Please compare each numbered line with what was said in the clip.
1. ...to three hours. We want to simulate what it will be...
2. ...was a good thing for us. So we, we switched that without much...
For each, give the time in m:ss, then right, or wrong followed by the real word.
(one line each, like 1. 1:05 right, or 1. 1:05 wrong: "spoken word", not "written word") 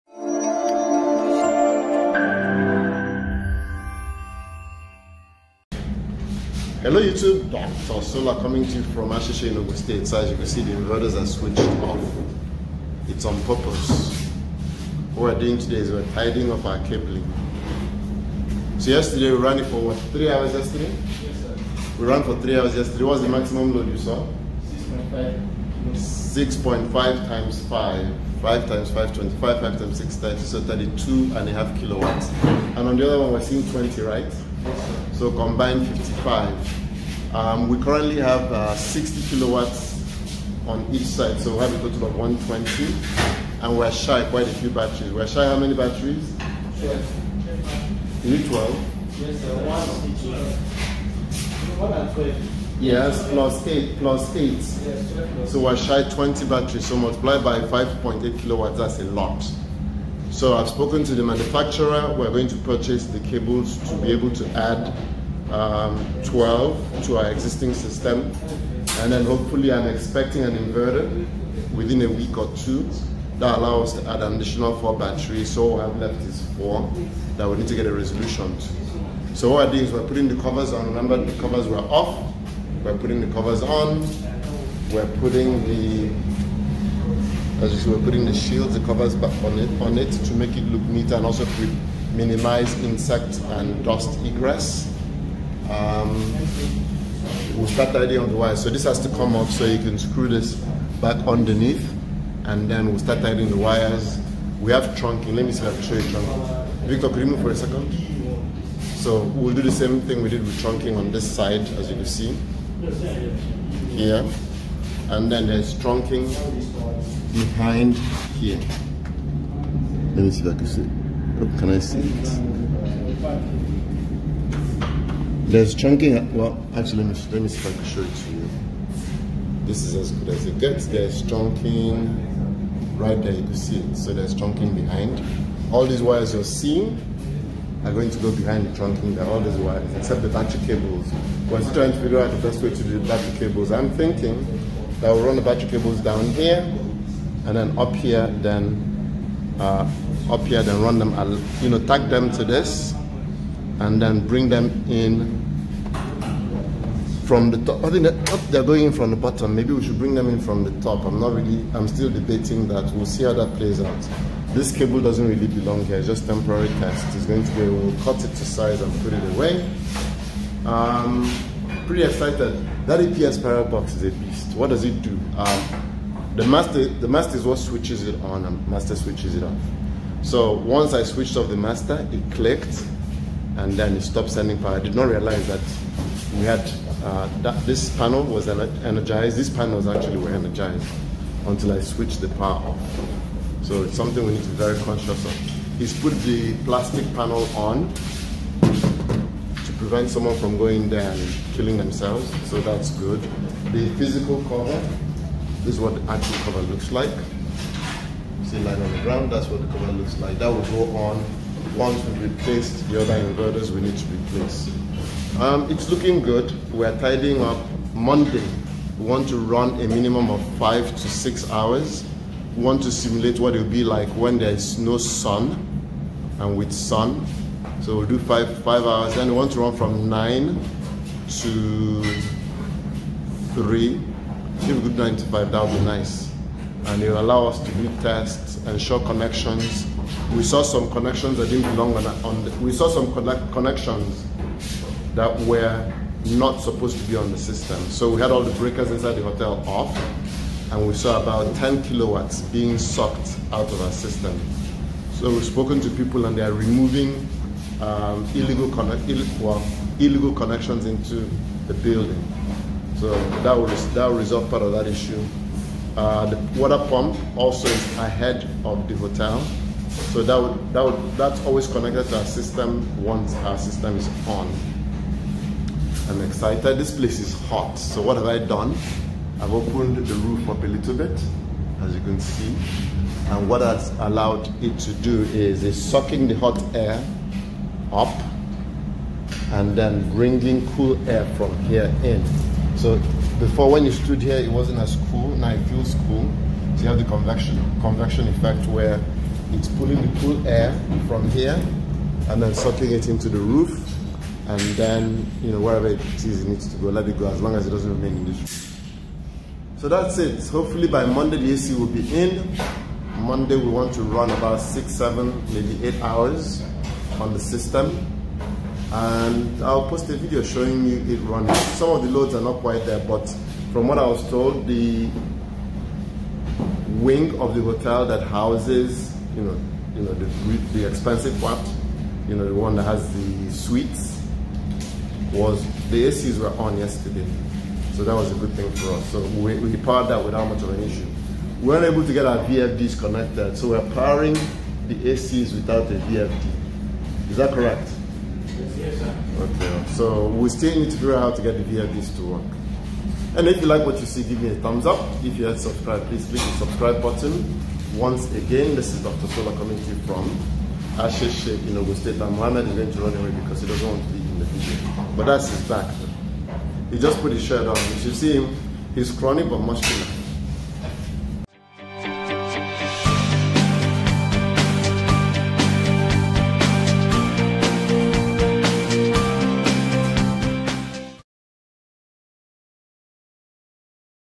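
1. 3:40 wrong: "six", not "three"
2. 5:38 wrong: "powered", not "switched".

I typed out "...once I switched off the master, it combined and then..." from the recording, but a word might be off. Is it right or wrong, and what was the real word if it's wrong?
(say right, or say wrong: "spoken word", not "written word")
wrong: "clicked", not "combined".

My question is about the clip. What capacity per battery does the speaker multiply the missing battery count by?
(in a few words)
5.8.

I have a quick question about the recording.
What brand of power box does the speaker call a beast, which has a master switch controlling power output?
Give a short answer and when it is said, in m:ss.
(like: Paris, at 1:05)
APS, at 2:52.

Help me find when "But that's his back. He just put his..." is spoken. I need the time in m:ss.
6:05.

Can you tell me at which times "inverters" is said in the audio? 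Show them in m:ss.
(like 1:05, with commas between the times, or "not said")
0:10, 1:10, 3:33.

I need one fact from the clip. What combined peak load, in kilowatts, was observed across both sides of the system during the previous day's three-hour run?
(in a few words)
55.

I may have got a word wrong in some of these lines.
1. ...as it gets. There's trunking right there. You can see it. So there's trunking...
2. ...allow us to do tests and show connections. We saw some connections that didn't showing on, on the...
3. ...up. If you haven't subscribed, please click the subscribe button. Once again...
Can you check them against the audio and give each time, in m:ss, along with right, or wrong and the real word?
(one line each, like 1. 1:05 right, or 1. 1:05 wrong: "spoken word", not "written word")
1. 2:10 right
2. 3:57 wrong: "belong", not "showing"
3. 5:54 right.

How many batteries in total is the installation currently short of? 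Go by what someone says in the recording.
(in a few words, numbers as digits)
20.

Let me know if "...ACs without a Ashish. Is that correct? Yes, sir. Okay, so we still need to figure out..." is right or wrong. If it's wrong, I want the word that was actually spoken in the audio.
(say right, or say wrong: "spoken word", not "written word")
wrong: "VFD", not "Ashish".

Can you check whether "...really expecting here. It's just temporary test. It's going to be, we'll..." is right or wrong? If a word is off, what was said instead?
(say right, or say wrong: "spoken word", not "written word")
wrong: "belong", not "expecting".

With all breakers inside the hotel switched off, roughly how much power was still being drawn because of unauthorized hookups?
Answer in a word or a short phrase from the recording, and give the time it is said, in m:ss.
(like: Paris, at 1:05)
10 kilowatts, at 4:11.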